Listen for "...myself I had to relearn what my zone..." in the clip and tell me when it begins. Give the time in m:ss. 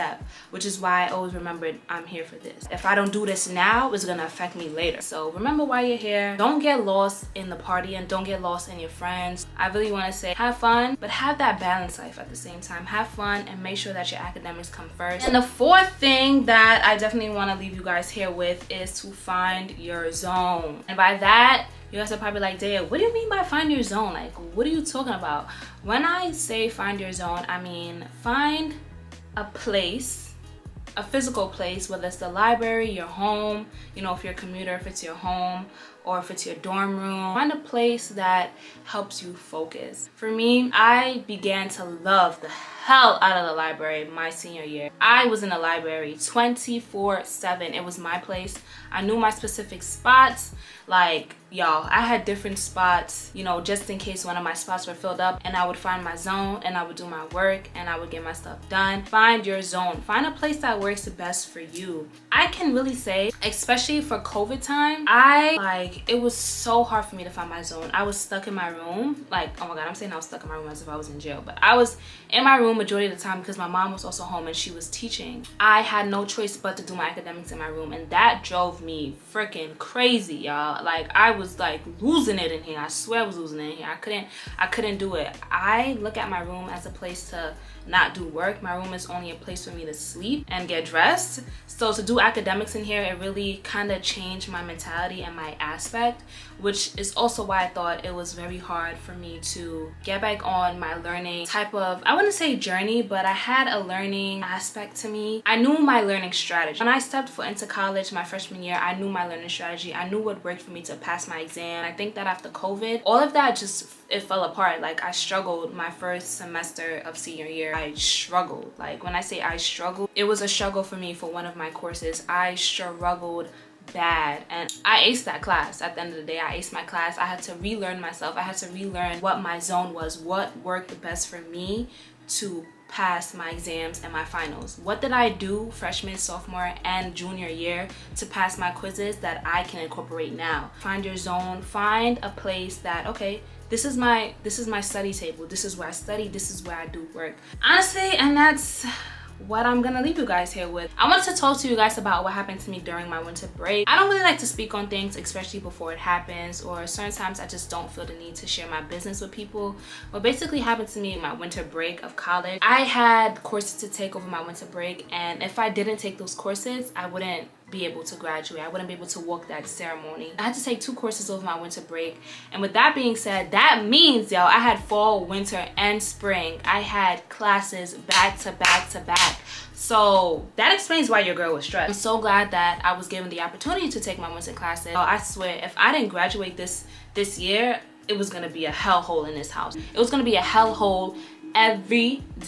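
2:07.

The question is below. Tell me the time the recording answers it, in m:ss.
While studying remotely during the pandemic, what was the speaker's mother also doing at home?
1:14.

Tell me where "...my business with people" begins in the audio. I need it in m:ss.
2:38.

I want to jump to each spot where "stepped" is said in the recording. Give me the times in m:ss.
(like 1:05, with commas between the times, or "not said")
1:46.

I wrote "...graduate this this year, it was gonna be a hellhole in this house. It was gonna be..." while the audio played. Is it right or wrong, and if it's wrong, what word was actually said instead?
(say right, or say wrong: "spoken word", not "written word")
right.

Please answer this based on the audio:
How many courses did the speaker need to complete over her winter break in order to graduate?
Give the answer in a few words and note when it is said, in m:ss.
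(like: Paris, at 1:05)
2, at 2:50.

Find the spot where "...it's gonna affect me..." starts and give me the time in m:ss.
0:03.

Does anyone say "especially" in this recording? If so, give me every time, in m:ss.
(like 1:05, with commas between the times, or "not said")
1:03, 2:35.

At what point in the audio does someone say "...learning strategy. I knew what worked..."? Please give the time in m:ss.
1:49.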